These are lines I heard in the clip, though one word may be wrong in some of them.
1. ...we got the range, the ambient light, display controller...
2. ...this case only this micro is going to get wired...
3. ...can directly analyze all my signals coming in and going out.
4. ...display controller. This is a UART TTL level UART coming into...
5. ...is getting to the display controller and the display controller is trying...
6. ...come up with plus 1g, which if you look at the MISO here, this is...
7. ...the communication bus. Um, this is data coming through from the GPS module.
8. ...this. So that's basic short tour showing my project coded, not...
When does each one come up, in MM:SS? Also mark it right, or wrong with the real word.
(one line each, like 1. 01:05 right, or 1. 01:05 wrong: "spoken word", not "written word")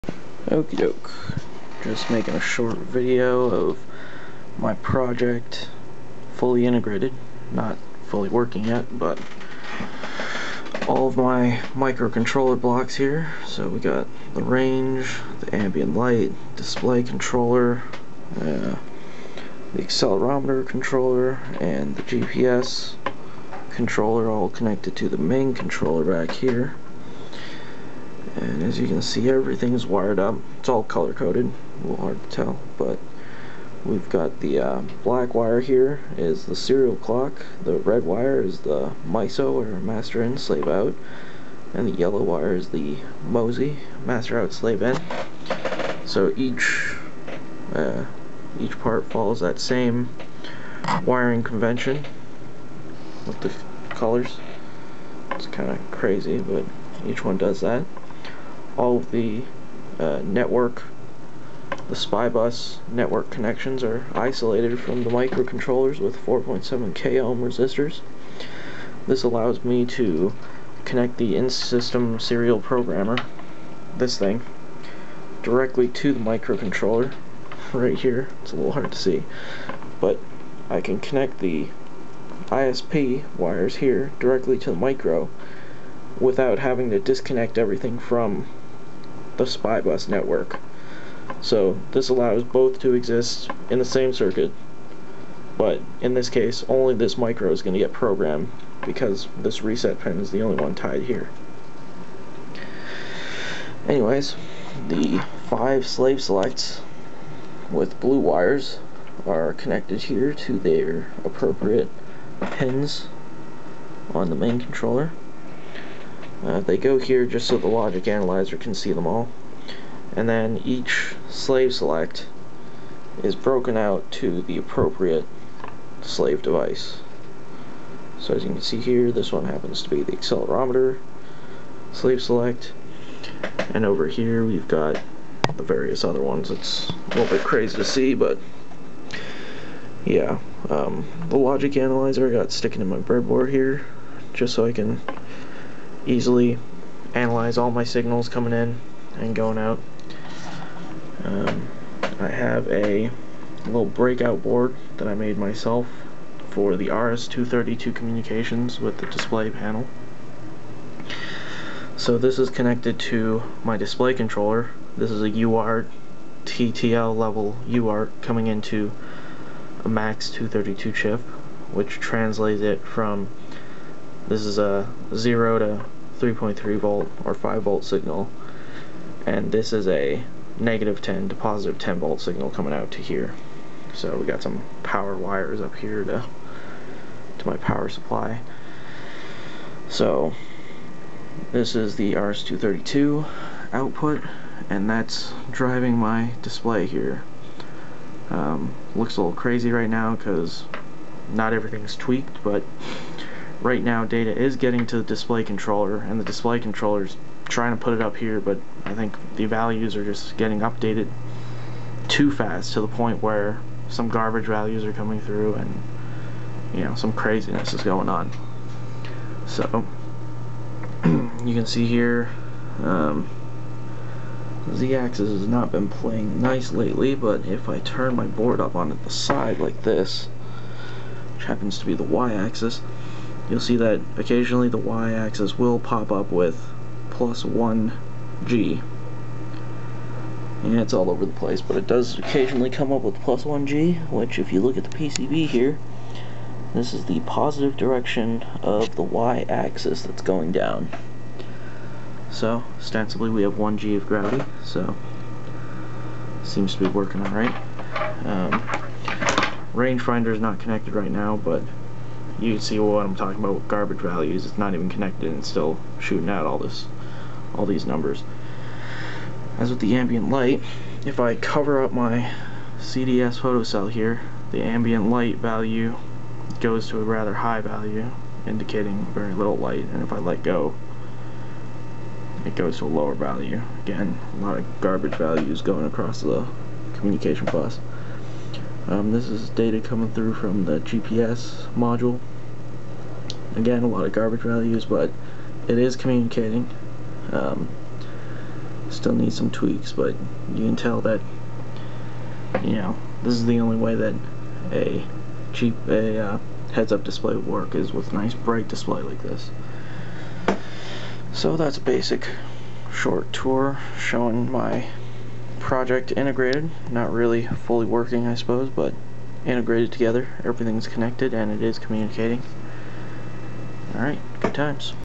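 1. 00:13 right
2. 01:36 wrong: "programmed", not "wired"
3. 02:24 wrong: "easily", not "directly"
4. 02:43 right
5. 03:24 right
6. 04:02 wrong: "PCB", not "MISO"
7. 04:46 right
8. 05:09 wrong: "integrated", not "coded".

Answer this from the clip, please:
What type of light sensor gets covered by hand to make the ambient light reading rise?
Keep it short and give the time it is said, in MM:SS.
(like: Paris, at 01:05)
CDS photocell, at 04:32.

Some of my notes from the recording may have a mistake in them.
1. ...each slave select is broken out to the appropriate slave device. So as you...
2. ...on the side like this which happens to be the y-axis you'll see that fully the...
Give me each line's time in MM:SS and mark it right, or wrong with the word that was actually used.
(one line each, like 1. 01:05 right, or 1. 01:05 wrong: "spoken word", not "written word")
1. 02:00 right
2. 03:48 wrong: "occasionally", not "fully".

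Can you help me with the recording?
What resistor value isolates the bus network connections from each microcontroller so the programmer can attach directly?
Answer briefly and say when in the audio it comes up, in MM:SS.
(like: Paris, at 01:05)
4.7 kΩ, at 01:06.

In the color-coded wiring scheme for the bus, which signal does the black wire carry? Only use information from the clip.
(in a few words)
serial clock.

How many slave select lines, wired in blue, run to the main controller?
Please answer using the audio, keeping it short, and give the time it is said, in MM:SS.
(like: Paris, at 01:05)
5, at 01:45.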